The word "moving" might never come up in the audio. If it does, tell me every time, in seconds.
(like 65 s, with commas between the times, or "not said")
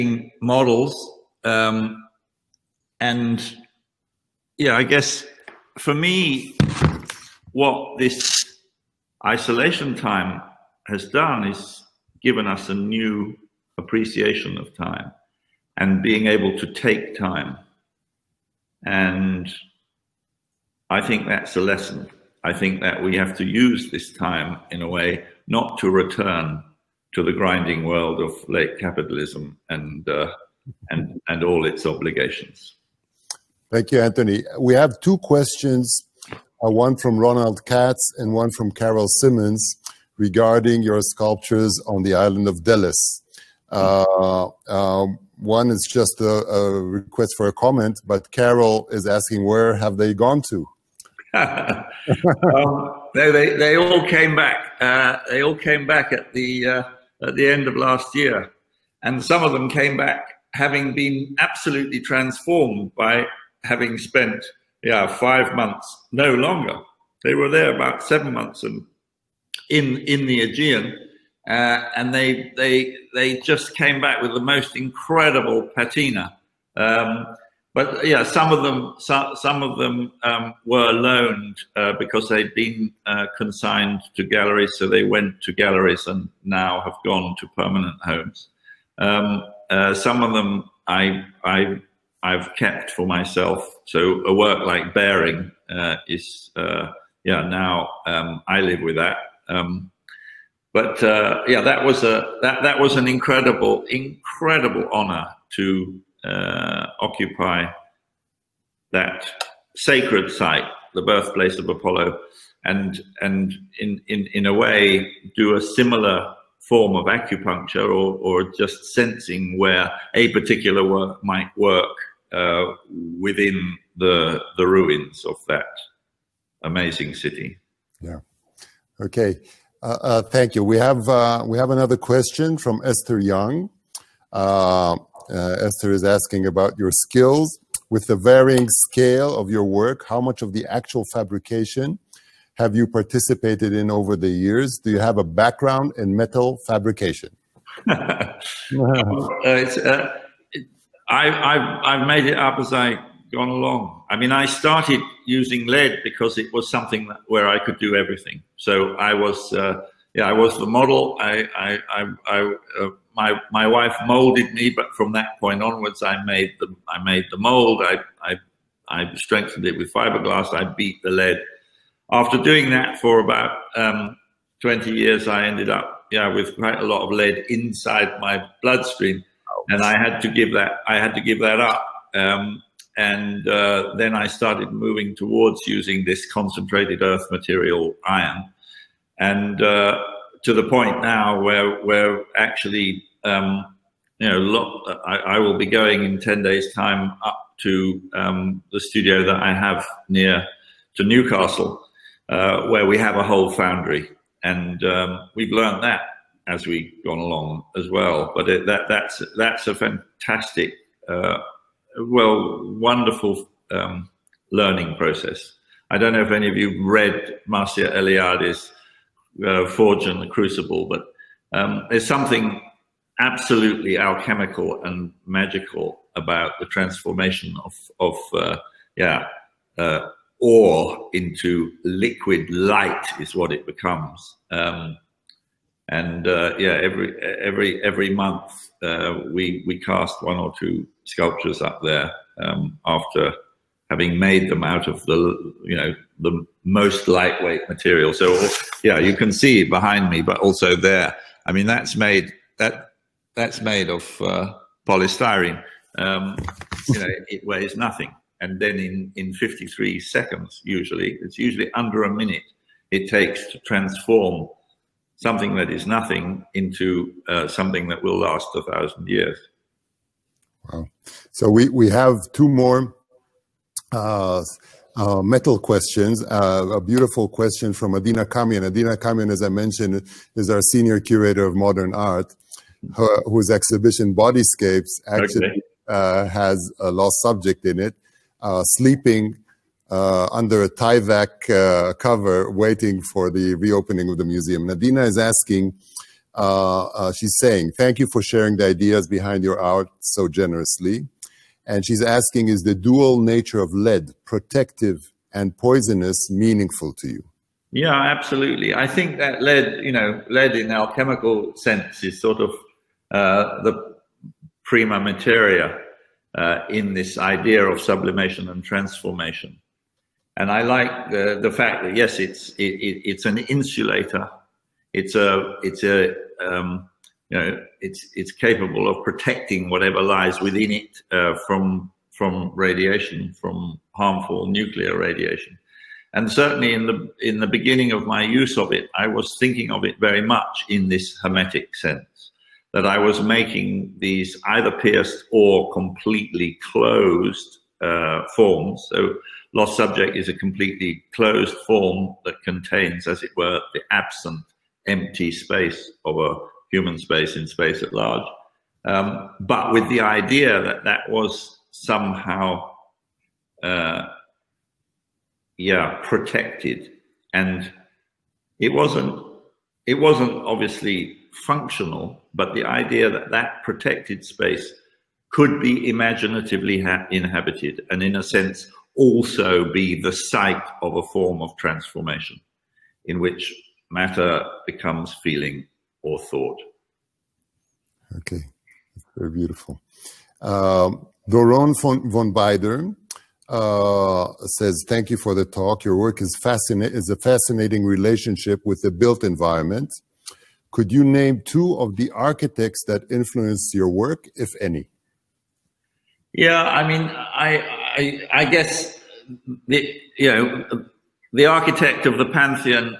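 184 s.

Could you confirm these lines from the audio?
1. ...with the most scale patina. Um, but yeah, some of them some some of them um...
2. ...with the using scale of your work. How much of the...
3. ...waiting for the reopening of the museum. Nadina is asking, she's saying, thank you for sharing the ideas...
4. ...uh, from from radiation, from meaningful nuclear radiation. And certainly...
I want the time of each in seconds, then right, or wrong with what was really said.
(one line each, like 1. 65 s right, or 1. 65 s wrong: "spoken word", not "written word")
1. 74 s wrong: "incredible", not "scale"
2. 137 s wrong: "varying", not "using"
3. 292 s right
4. 331 s wrong: "harmful", not "meaningful".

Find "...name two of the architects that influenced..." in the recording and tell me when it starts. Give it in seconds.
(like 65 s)
401 s.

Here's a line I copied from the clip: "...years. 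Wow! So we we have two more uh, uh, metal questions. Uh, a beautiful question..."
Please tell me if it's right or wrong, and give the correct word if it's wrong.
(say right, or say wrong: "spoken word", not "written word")
right.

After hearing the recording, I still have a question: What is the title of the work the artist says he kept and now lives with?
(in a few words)
Bearing.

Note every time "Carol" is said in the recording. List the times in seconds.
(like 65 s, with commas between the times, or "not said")
38 s, 48 s.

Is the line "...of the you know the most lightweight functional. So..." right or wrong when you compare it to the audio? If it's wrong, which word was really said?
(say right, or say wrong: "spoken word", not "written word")
wrong: "material", not "functional".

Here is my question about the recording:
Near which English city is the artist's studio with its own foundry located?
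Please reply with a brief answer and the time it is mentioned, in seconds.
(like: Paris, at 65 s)
Newcastle, at 201 s.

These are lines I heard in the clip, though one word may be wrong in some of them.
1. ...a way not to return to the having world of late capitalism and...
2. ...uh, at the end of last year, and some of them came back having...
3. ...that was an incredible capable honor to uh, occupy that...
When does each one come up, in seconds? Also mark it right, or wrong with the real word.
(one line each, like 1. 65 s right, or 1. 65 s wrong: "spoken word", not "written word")
1. 24 s wrong: "grinding", not "having"
2. 56 s right
3. 102 s wrong: "incredible", not "capable".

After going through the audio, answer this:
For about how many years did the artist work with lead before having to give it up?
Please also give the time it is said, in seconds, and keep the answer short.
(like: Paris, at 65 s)
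20, at 174 s.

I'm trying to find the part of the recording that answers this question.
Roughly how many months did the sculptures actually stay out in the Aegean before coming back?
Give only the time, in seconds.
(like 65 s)
68 s.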